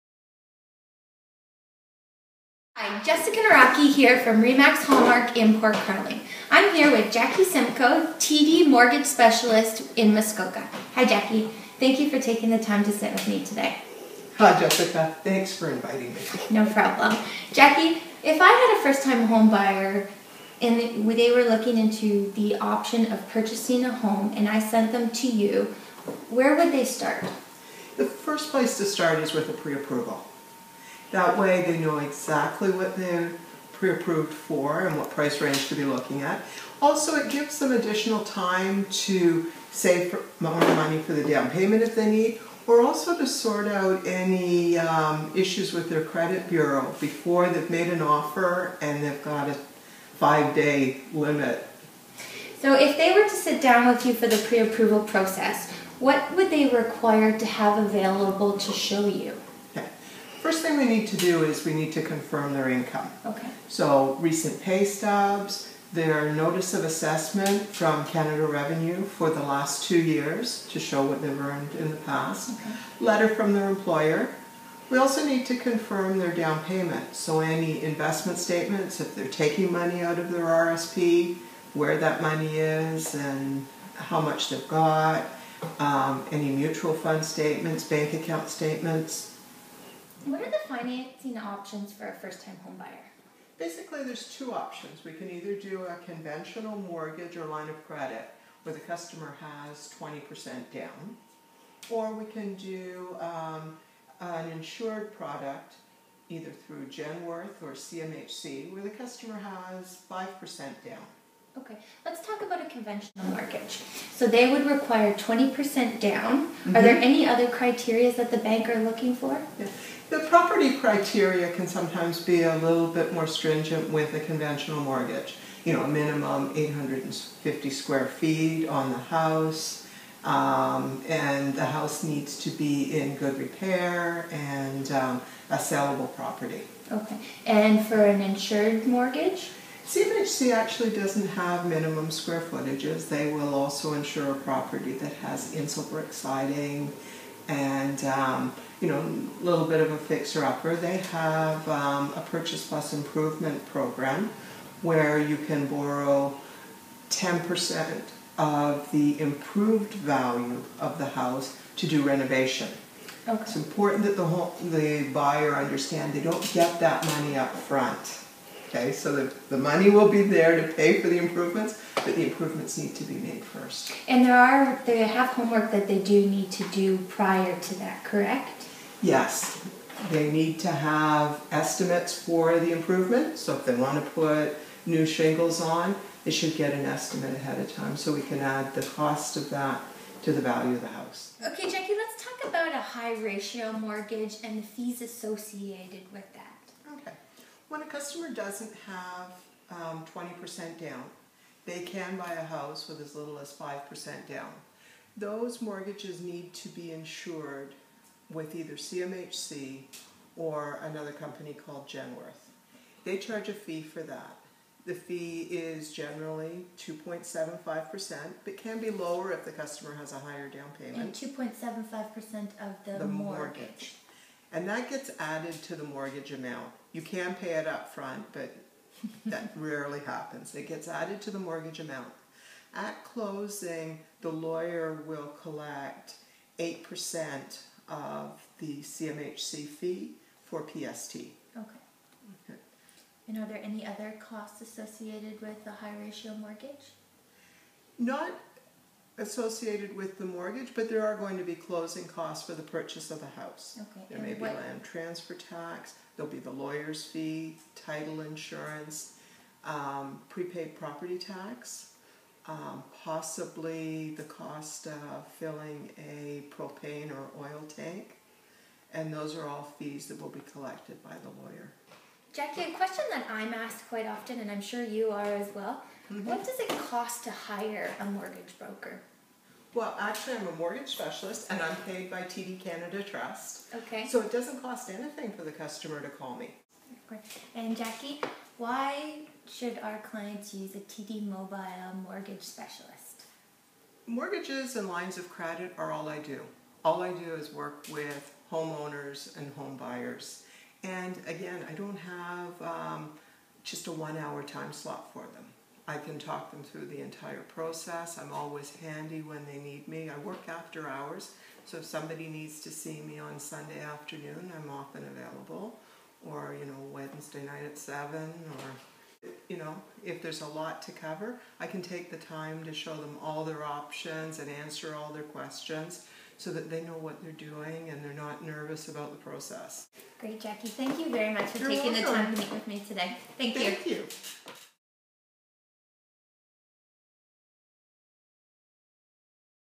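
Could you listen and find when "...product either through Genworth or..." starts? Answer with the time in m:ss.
1:45.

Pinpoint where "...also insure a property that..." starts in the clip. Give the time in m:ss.
2:23.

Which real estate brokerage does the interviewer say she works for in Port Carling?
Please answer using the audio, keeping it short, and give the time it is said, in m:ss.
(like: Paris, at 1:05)
Remax Hallmark, at 0:04.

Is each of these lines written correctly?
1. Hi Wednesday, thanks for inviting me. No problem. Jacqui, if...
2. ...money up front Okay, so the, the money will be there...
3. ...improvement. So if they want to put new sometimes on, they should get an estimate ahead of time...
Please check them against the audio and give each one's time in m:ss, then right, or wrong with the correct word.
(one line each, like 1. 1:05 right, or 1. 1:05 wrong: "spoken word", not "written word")
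1. 0:14 wrong: "Jessica", not "Wednesday"
2. 2:47 right
3. 3:02 wrong: "shingles", not "sometimes".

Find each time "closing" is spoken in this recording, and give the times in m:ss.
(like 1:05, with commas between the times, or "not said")
3:53, 4:11.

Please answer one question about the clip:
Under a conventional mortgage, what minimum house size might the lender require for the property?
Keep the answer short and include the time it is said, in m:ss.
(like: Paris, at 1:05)
850 square feet, at 2:06.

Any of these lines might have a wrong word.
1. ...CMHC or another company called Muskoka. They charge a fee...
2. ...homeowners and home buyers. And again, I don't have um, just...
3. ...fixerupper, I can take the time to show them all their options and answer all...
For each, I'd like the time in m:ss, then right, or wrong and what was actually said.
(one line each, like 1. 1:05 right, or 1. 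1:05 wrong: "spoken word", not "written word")
1. 3:28 wrong: "Genworth", not "Muskoka"
2. 4:58 right
3. 5:20 wrong: "cover", not "fixerupper".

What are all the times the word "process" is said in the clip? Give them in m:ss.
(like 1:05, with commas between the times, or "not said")
0:55, 5:07, 5:29.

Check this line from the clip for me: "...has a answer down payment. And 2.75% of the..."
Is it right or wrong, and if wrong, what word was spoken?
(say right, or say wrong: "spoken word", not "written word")
wrong: "higher", not "answer".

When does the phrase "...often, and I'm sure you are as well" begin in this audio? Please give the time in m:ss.
4:34.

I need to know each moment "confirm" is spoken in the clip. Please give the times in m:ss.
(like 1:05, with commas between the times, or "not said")
1:02, 1:15.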